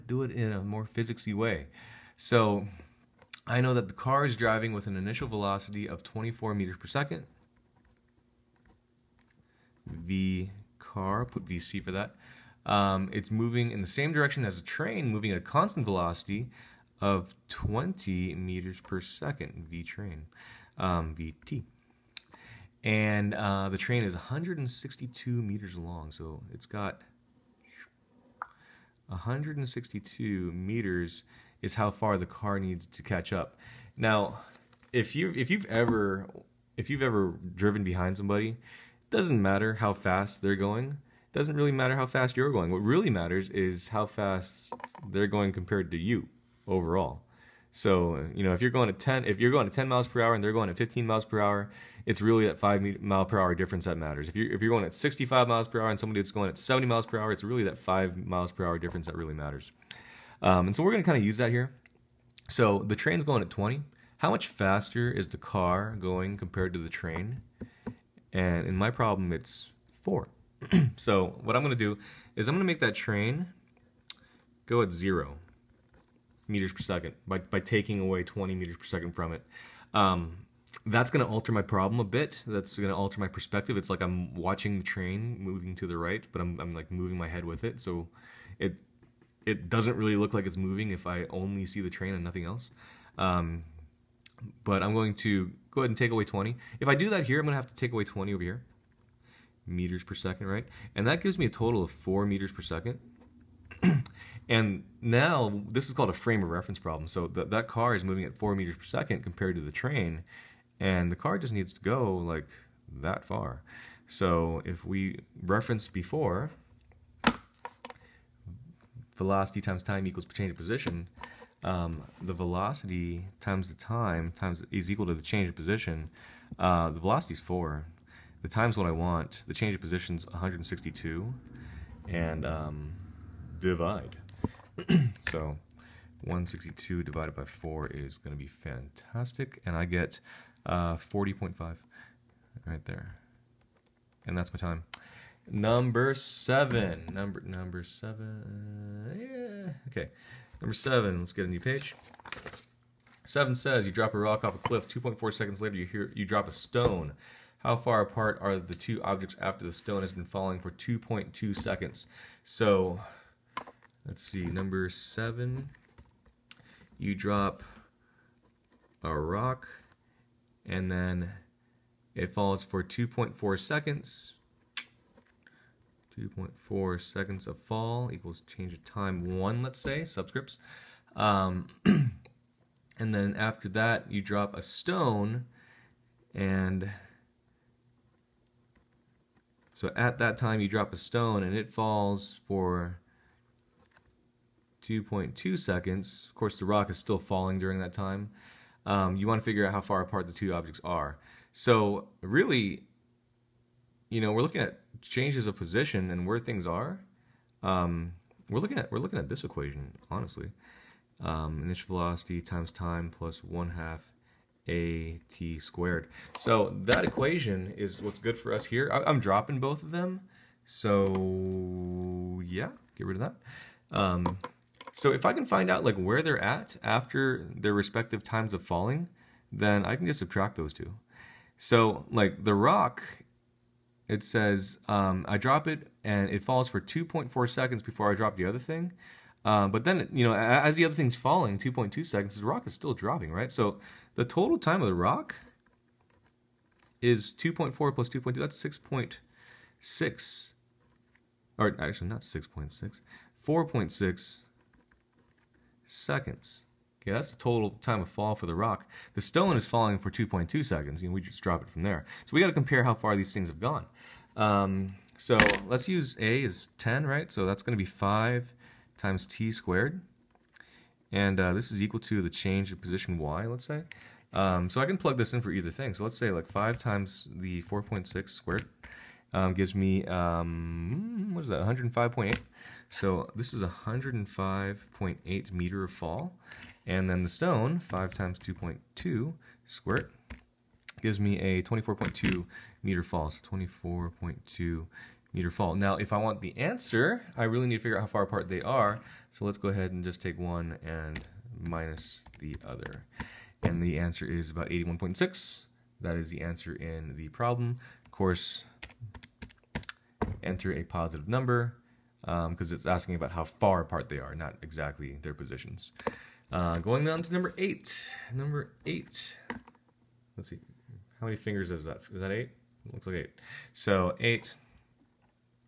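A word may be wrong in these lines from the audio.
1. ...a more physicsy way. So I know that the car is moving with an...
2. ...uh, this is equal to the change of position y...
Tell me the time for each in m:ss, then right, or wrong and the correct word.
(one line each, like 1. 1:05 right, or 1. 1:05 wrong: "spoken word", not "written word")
1. 0:00 wrong: "driving", not "moving"
2. 4:31 right.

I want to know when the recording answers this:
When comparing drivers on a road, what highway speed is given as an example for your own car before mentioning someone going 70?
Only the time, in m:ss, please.
0:54.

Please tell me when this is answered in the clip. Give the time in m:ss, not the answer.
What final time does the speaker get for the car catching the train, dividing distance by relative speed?
2:20.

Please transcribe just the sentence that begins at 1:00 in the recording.
Um, and so we're going to kind of use that here.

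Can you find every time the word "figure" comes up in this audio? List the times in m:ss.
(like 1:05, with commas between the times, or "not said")
3:19, 4:57.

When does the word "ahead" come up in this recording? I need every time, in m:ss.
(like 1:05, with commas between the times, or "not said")
1:35, 4:59.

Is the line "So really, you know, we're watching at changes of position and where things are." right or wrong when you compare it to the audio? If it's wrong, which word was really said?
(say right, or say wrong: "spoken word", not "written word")
wrong: "looking", not "watching".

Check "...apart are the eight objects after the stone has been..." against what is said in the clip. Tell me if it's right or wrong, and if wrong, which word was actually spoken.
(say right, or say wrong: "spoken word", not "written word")
wrong: "two", not "eight".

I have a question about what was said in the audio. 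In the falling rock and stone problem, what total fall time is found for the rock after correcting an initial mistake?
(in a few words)
4.6 seconds.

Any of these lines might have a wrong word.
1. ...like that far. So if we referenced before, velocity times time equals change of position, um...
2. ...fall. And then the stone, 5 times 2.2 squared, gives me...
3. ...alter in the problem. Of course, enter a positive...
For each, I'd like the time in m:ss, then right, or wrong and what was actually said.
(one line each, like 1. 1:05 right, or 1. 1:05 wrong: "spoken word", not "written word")
1. 1:52 right
2. 4:45 right
3. 5:06 wrong: "answer", not "alter".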